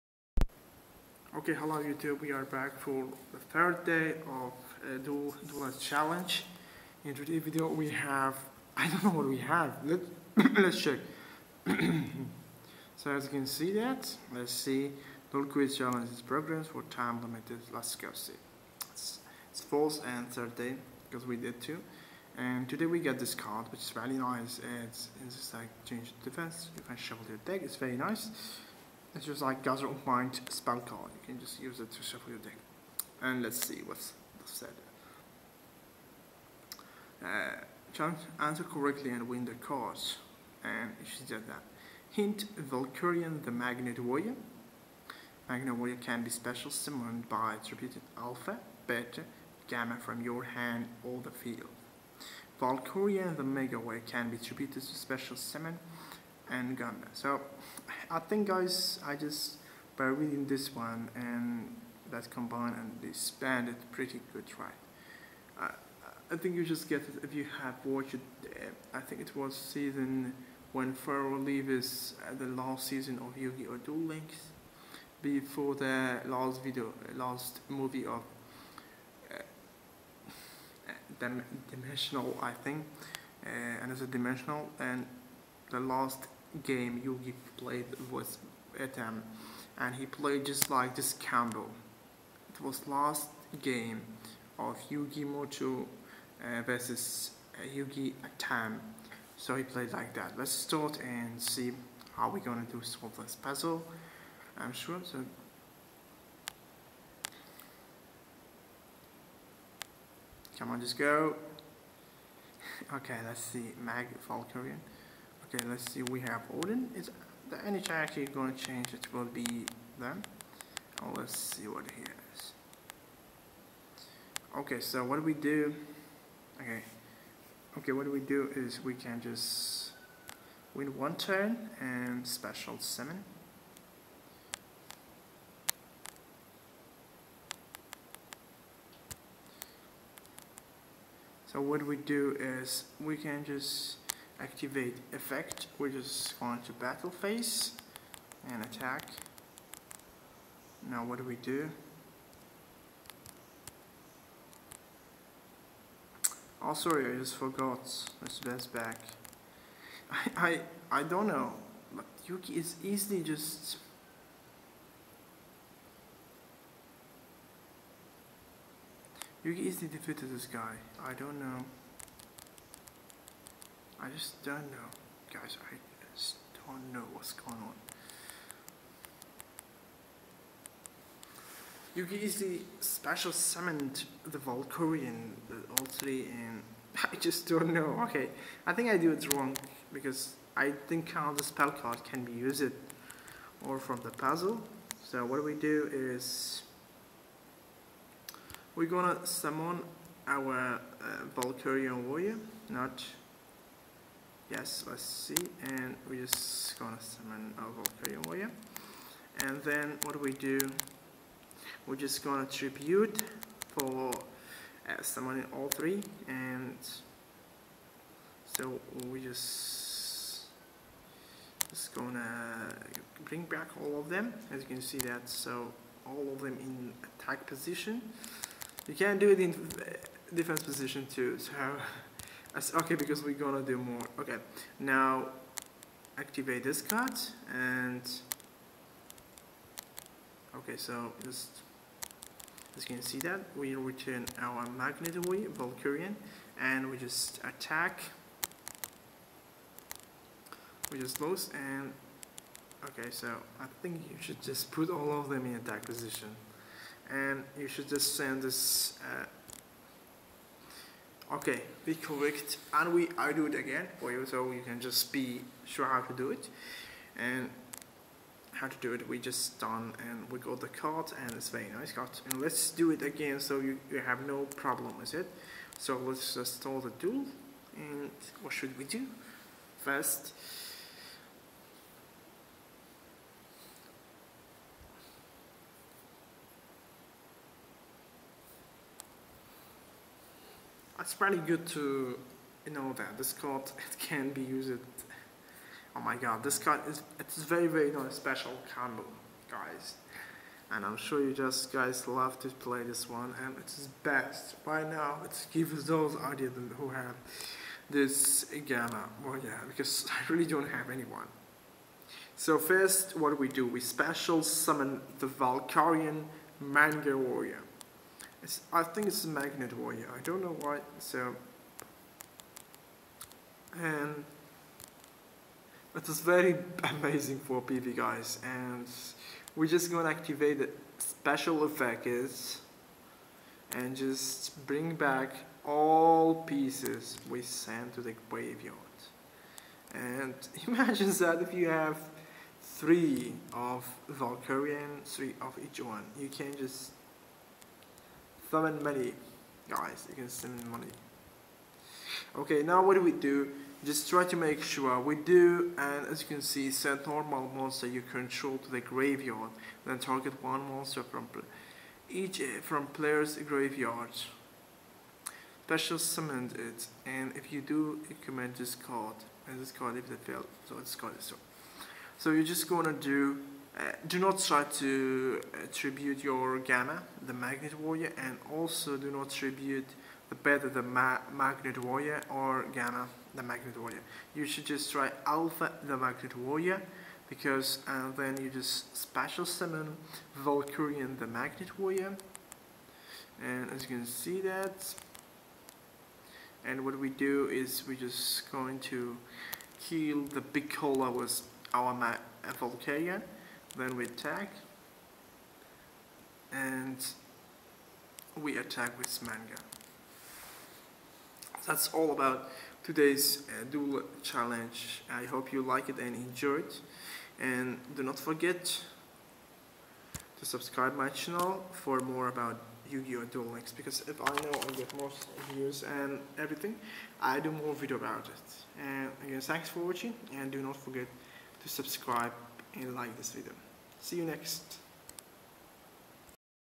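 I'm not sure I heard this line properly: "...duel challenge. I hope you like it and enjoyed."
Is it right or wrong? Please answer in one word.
right.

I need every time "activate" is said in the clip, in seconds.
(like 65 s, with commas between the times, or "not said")
144 s, 236 s, 330 s.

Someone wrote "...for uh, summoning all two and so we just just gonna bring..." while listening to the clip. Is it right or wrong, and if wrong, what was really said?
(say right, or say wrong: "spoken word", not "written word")
wrong: "three", not "two".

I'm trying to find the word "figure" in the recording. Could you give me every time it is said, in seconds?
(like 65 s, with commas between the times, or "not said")
not said.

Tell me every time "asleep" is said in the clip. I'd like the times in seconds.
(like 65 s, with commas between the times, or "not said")
not said.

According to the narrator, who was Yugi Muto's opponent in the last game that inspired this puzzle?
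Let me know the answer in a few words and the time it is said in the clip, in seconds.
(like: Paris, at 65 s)
Yugi Atem, at 97 s.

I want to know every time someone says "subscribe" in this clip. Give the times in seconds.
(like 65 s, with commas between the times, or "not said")
420 s, 431 s.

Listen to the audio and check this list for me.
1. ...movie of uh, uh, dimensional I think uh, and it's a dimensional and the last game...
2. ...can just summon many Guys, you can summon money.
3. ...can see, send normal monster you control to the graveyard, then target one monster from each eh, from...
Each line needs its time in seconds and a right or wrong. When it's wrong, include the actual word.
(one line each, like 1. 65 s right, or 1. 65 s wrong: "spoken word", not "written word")
1. 77 s right
2. 346 s right
3. 356 s right.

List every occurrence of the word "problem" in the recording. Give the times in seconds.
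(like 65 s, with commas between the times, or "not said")
274 s.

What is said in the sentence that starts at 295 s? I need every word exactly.
Oh my god, this card is it's very very special combo, guys.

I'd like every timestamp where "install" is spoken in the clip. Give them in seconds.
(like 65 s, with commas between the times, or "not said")
276 s.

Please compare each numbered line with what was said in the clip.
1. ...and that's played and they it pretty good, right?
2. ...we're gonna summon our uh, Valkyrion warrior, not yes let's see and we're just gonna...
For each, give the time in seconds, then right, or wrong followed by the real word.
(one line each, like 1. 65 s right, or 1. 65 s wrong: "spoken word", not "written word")
1. 61 s wrong: "combined", not "played"
2. 198 s right.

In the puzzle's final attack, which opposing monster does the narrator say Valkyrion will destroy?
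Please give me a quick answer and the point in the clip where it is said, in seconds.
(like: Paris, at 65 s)
Big Cola, at 400 s.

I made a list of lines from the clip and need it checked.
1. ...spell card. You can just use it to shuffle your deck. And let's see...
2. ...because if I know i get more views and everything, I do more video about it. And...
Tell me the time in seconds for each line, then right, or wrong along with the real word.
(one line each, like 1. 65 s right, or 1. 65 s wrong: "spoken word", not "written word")
1. 30 s right
2. 423 s right.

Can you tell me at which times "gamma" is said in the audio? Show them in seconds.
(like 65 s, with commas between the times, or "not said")
49 s, 308 s, 376 s, 382 s.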